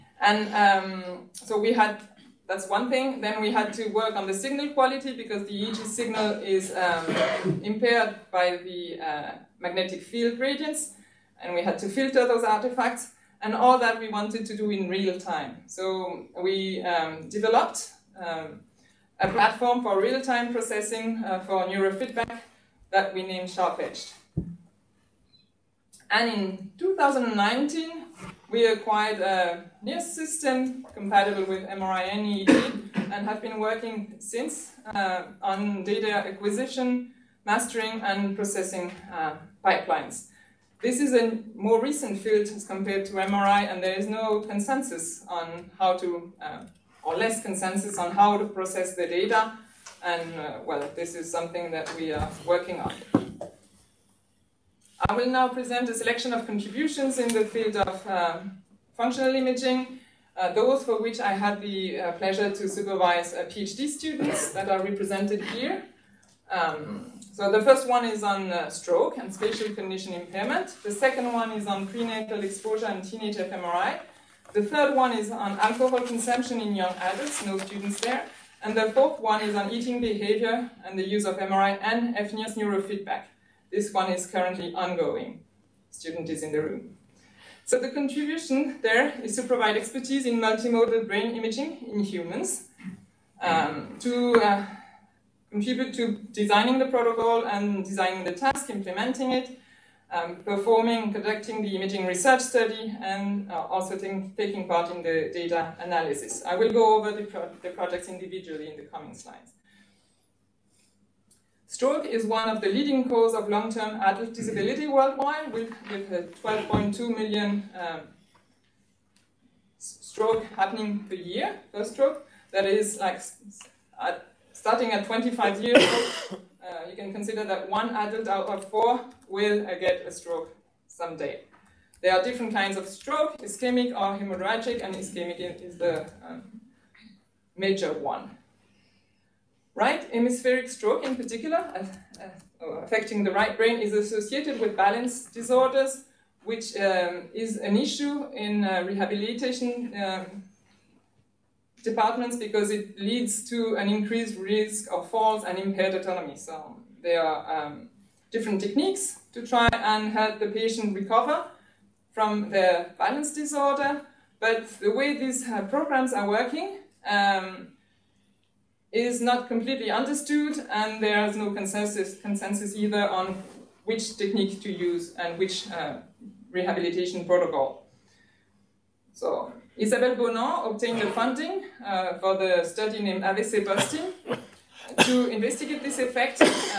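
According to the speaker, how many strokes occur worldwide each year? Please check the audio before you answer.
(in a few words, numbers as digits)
12.2 million.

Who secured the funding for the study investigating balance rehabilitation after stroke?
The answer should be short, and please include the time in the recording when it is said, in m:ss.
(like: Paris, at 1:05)
Isabelle Bonan, at 2:59.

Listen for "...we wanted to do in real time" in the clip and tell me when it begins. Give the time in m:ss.
0:13.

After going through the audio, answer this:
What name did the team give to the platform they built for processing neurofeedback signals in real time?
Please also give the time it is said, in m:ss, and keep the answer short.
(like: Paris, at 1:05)
SharpEdge, at 0:23.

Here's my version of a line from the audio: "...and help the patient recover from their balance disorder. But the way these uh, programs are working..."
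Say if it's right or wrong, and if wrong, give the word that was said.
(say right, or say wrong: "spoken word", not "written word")
right.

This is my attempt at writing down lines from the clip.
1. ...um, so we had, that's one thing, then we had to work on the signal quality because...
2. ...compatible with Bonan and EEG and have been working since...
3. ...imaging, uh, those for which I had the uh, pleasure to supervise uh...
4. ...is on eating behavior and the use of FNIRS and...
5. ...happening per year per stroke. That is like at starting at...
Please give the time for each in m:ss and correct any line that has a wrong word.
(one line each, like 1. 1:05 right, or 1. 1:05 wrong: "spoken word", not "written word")
1. 0:00 right
2. 0:30 wrong: "MRI", not "Bonan"
3. 0:59 right
4. 1:19 wrong: "MRI", not "FNIRS"
5. 2:00 right.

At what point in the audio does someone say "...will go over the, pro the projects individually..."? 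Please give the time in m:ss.
1:46.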